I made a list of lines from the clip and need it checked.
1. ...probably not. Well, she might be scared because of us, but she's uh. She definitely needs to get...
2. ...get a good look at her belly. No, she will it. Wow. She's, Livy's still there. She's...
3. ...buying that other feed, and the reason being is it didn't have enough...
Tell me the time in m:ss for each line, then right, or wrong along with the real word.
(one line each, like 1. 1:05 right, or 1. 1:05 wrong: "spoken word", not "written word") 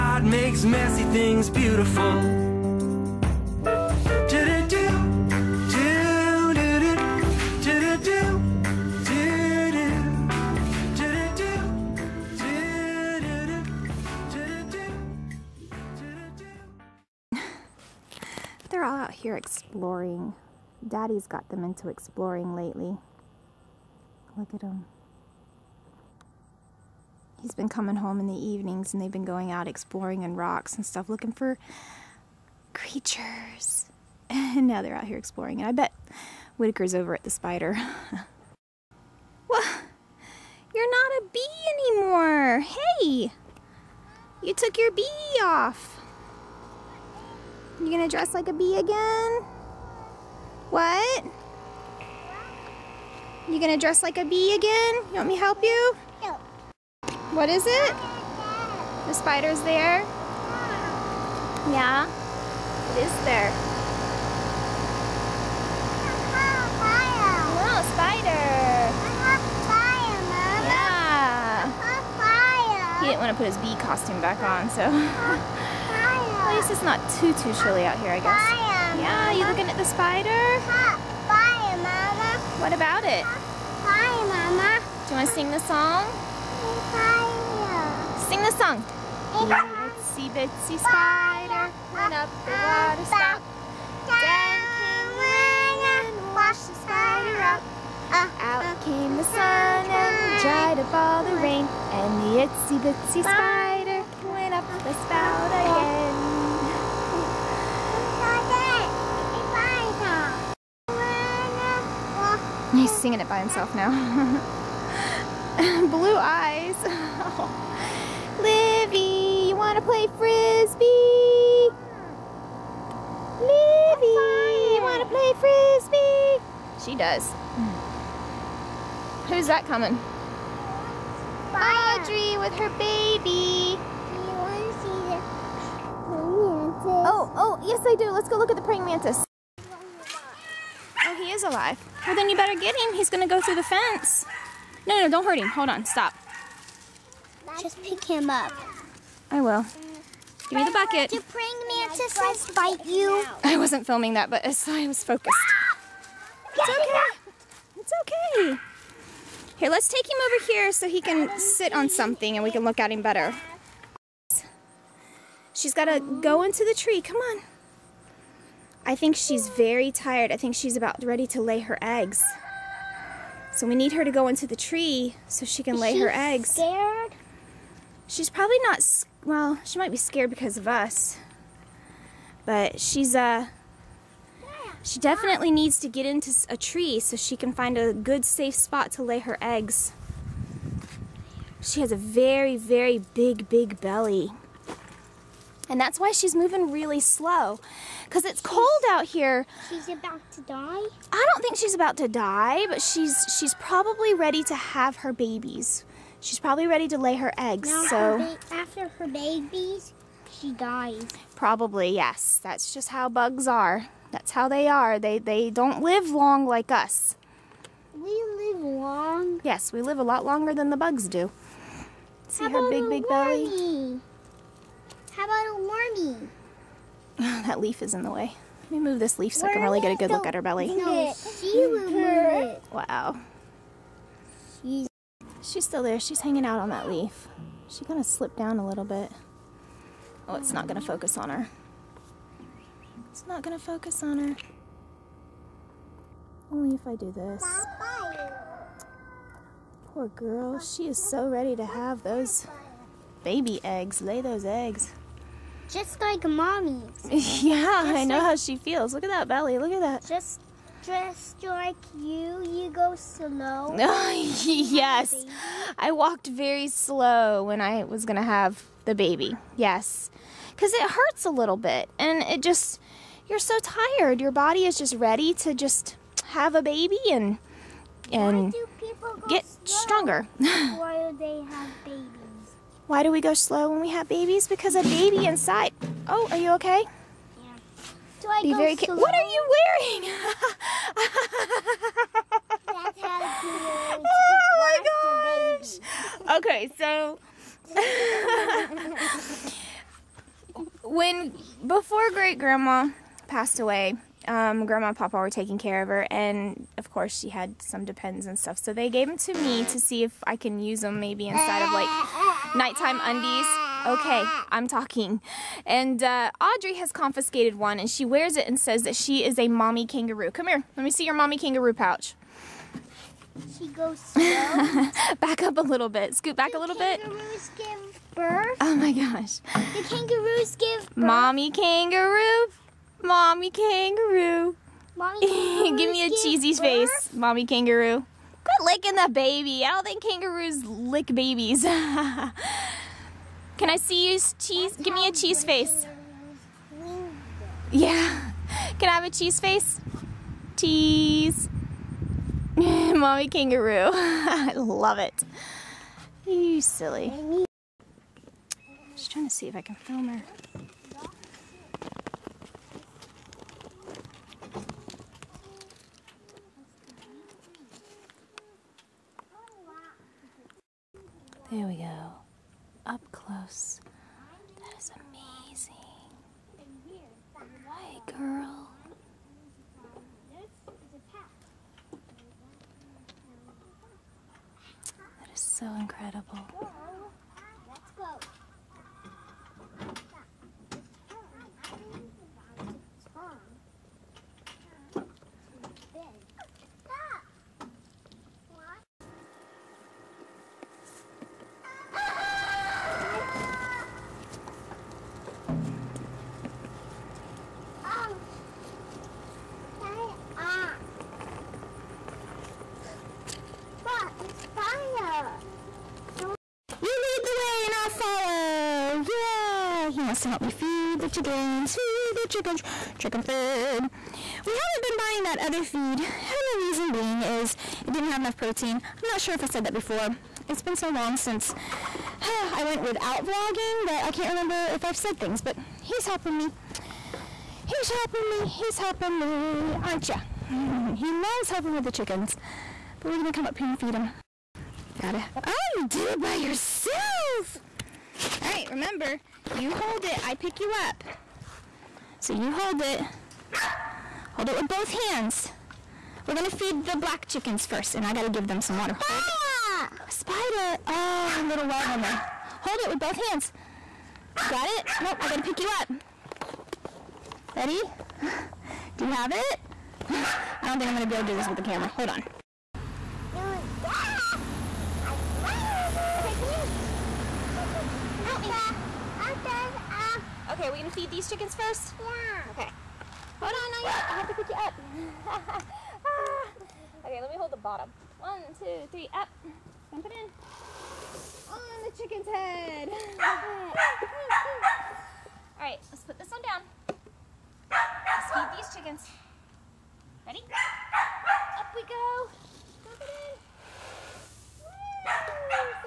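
1. 2:58 right
2. 3:49 wrong: "She", not "Livy"
3. 7:04 right.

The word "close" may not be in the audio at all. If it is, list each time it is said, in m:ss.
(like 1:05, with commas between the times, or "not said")
6:13.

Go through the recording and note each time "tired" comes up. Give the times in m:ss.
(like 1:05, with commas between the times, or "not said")
2:49, 4:33.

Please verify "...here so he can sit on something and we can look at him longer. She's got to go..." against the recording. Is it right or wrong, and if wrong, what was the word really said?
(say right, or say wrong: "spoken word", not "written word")
wrong: "better", not "longer".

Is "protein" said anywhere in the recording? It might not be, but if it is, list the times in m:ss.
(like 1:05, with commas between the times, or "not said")
7:08.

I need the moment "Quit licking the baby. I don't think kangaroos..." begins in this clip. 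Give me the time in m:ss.
5:38.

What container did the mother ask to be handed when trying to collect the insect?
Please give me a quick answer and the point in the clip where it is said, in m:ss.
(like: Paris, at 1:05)
The bucket, at 2:30.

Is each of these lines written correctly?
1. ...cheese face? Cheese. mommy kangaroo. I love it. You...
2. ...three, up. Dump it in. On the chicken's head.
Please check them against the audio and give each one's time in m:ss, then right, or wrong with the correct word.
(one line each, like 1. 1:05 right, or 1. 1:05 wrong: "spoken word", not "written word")
1. 5:49 right
2. 8:08 right.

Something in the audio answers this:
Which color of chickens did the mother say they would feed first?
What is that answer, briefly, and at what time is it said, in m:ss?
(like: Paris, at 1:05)
Black, at 7:36.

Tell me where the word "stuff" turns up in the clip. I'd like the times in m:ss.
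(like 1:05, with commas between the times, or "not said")
0:30, 5:08.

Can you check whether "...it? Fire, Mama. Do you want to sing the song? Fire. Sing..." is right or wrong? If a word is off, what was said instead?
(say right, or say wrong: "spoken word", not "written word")
right.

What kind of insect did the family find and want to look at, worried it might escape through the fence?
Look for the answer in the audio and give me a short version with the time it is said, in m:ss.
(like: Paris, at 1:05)
Praying mantis, at 2:18.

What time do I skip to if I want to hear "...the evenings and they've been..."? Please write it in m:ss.
0:28.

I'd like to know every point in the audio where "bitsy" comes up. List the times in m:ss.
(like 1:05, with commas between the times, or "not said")
1:30, 1:42.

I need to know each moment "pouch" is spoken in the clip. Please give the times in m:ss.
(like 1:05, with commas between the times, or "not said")
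5:21.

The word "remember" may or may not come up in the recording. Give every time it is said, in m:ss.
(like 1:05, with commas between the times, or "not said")
7:14, 7:28.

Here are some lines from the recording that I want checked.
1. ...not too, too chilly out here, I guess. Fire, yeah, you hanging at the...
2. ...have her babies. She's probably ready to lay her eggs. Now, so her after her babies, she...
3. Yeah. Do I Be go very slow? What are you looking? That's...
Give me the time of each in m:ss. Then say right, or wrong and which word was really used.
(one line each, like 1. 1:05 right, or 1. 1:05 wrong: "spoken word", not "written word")
1. 1:16 wrong: "looking", not "hanging"
2. 3:24 right
3. 4:47 wrong: "wearing", not "looking".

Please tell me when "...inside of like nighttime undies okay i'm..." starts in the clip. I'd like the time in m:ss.
5:11.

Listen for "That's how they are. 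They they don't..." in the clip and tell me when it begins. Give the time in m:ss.
3:34.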